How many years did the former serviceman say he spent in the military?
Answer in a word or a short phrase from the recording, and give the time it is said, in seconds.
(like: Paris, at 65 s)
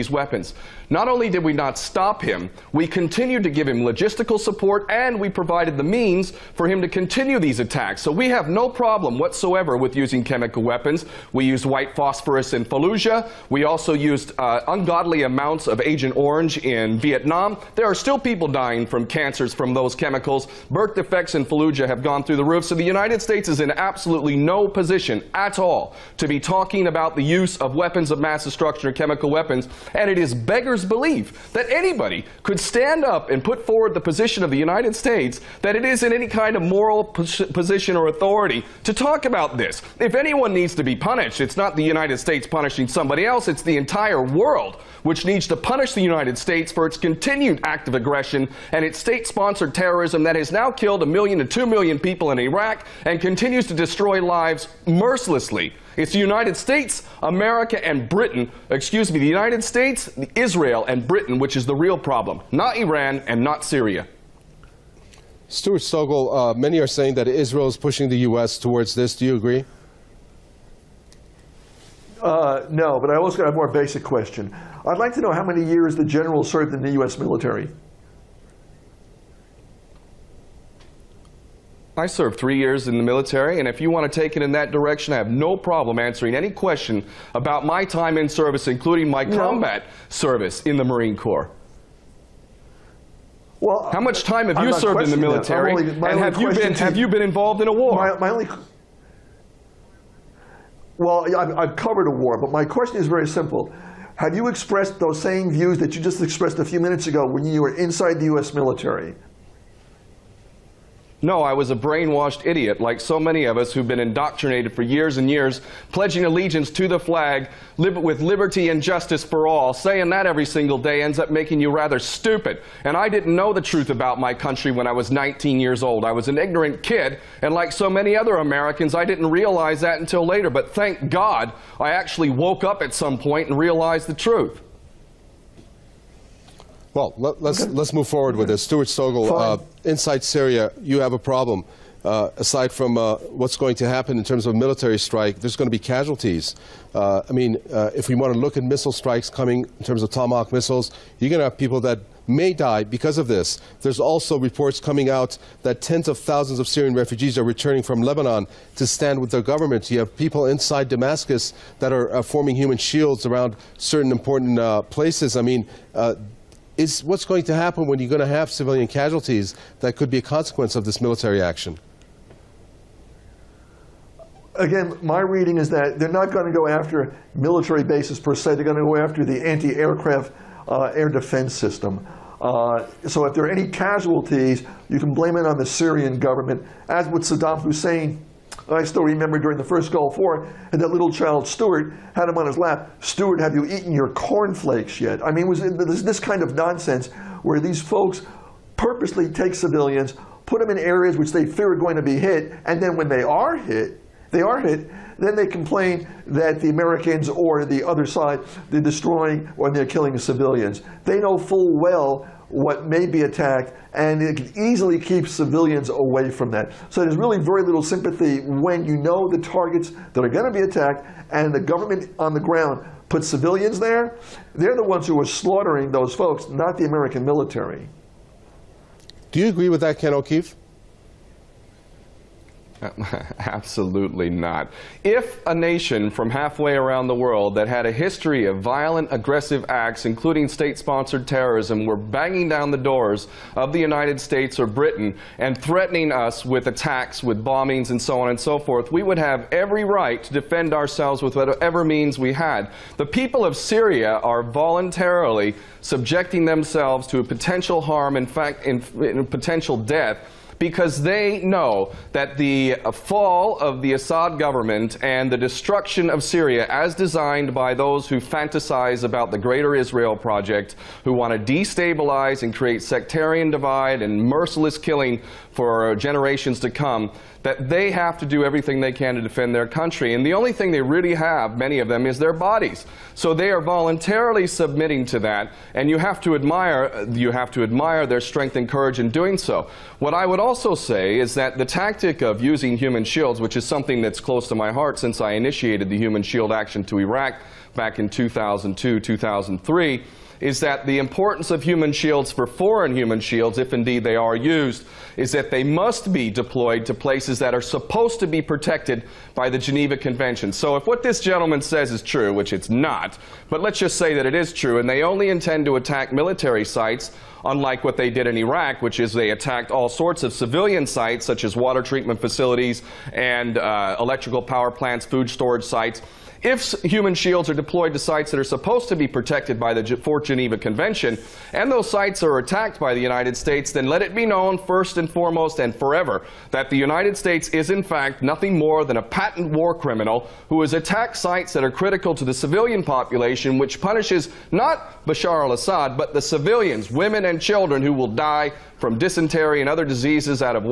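3, at 82 s.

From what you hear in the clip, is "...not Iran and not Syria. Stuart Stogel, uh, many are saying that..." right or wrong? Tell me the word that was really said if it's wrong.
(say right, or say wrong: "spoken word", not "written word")
right.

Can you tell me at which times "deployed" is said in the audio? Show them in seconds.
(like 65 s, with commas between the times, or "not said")
306 s, 327 s.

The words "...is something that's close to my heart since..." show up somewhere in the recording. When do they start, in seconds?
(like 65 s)
293 s.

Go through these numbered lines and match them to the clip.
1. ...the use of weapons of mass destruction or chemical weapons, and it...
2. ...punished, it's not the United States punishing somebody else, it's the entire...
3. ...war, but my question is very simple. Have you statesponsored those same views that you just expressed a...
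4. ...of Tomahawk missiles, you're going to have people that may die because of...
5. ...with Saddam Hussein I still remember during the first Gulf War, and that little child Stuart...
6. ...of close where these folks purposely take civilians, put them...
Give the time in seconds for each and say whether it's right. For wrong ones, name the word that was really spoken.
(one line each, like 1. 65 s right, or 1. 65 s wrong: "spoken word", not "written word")
1. 27 s right
2. 40 s right
3. 102 s wrong: "expressed", not "statesponsored"
4. 150 s right
5. 187 s right
6. 196 s wrong: "nonsense", not "close".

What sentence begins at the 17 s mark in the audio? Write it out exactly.
There are still people dying from cancers from from those chemicals.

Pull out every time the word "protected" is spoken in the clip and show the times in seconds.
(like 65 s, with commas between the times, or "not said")
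308 s, 329 s.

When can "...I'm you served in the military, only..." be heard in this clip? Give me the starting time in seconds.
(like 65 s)
94 s.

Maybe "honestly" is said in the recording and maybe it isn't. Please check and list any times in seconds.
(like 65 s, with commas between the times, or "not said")
not said.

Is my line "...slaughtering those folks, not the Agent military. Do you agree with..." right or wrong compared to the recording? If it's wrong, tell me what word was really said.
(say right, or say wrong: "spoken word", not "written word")
wrong: "American", not "Agent".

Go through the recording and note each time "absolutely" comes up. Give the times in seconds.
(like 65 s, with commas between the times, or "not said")
23 s, 233 s.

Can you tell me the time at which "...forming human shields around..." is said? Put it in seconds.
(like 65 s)
162 s.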